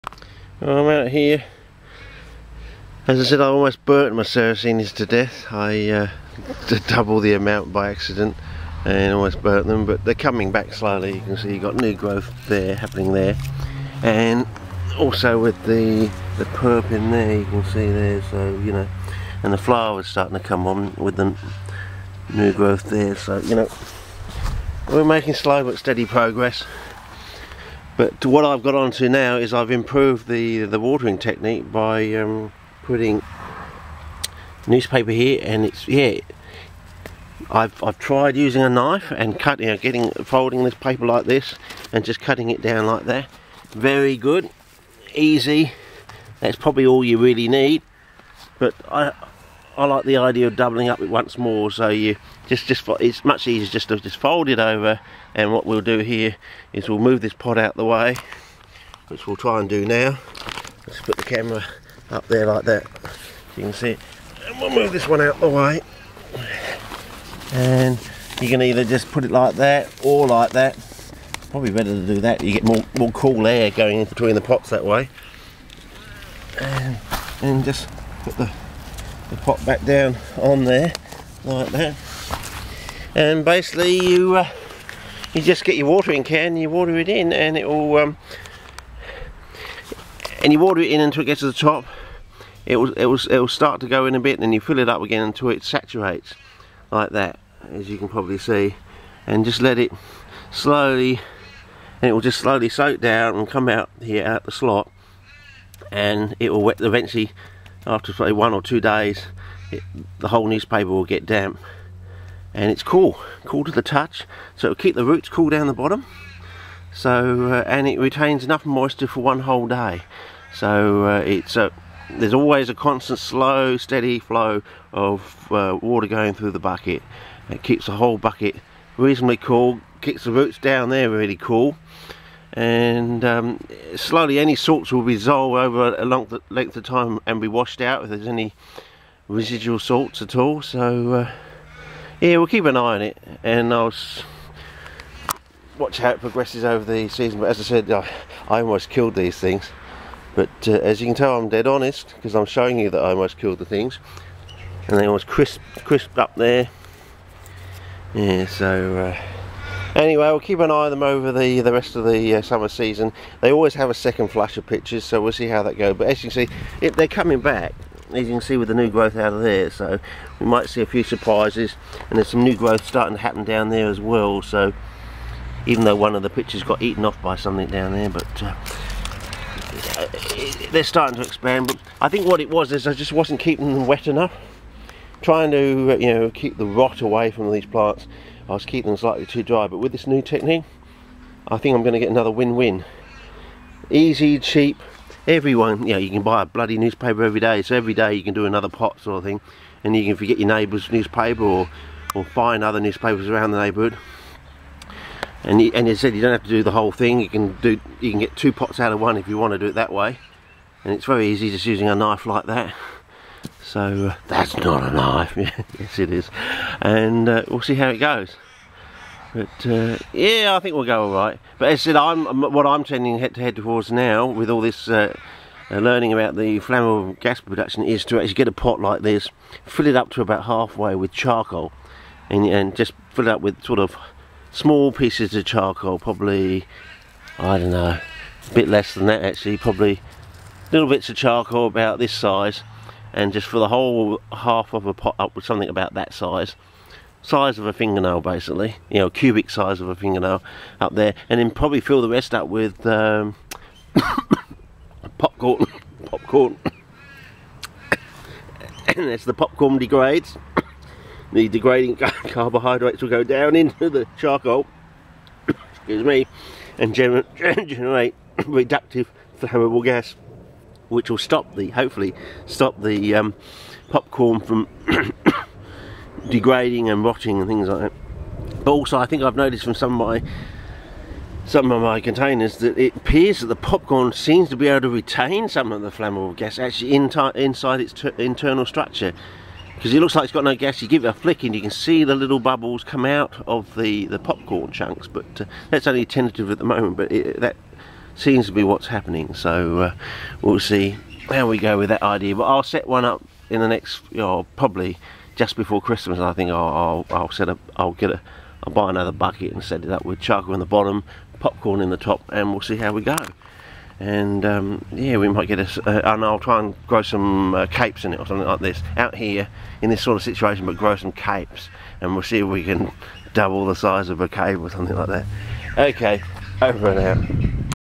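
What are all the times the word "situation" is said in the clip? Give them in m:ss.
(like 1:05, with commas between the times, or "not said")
5:20.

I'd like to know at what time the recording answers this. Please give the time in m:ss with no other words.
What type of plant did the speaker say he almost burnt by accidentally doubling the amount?
0:04.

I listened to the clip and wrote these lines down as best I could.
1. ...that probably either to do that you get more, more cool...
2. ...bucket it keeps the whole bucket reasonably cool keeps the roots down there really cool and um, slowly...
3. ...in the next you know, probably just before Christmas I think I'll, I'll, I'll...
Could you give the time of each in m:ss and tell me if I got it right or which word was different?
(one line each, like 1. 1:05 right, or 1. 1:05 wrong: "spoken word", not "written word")
1. 1:10 wrong: "better", not "either"
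2. 2:06 right
3. 5:03 right.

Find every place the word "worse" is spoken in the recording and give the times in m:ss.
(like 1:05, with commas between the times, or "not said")
not said.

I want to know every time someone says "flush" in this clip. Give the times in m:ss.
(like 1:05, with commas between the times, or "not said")
2:44.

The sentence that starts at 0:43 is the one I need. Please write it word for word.
Very good, easy, that's probably all you really need.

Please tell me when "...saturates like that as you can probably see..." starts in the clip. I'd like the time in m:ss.
1:35.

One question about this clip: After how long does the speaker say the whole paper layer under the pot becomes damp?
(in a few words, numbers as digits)
1 or 2 days.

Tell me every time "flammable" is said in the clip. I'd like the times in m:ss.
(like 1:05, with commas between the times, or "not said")
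3:46, 4:29, 4:45.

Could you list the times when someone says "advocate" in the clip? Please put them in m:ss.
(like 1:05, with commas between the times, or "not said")
not said.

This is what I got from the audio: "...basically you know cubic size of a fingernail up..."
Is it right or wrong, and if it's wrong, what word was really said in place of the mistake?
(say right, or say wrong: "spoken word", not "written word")
right.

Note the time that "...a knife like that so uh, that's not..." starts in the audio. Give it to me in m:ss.
3:31.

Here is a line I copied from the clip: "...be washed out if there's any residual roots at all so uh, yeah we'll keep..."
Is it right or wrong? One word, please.
wrong.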